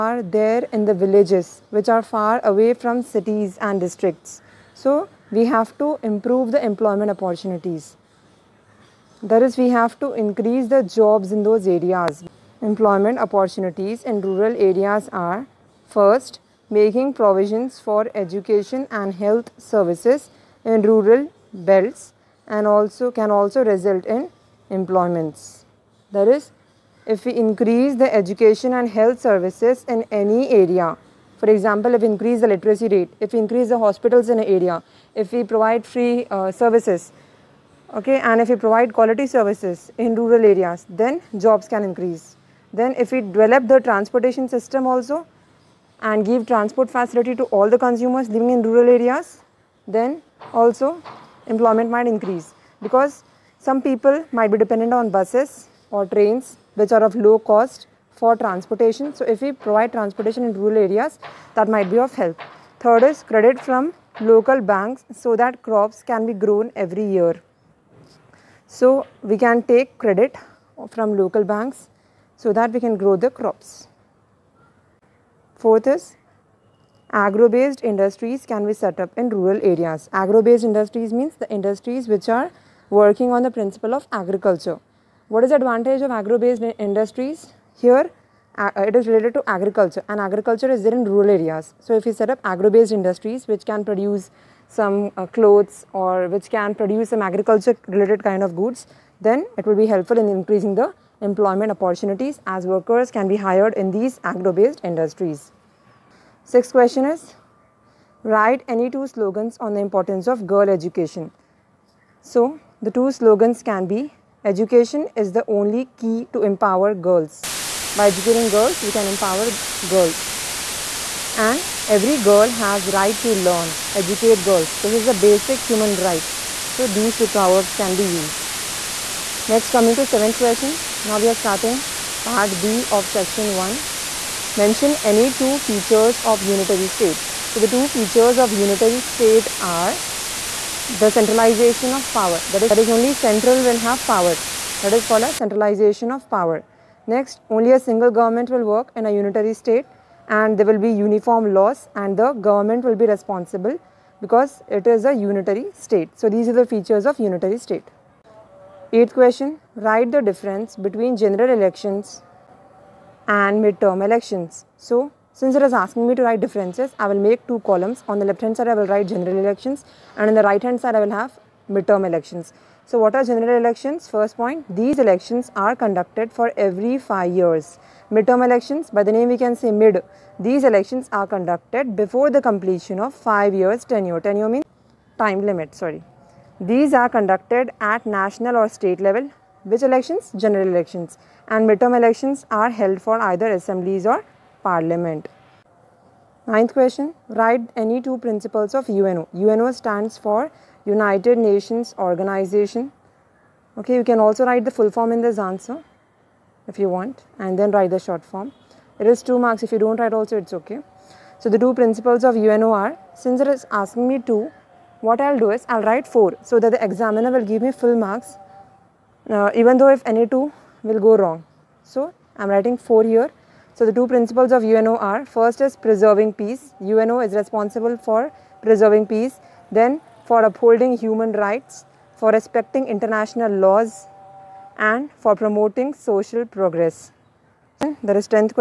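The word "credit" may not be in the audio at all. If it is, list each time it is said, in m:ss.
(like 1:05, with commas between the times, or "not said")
1:03, 1:09.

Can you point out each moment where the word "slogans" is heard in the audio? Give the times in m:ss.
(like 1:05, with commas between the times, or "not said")
1:49, 1:53.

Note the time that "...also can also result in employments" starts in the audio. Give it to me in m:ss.
0:22.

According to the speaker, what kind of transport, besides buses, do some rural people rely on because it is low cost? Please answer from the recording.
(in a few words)
Trains.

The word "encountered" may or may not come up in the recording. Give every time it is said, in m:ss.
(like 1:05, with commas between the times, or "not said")
not said.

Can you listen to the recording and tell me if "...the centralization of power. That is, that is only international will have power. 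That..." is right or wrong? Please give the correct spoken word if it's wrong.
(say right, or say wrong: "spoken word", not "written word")
wrong: "central", not "international".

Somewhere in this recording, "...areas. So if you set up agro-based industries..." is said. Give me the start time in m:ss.
1:31.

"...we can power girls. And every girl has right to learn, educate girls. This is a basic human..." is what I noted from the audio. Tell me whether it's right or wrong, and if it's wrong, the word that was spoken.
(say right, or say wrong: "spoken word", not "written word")
wrong: "empower", not "power".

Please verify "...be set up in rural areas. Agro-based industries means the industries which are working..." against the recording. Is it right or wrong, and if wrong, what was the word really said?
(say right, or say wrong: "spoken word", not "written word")
right.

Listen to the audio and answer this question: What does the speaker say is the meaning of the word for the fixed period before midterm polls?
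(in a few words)
Time limit.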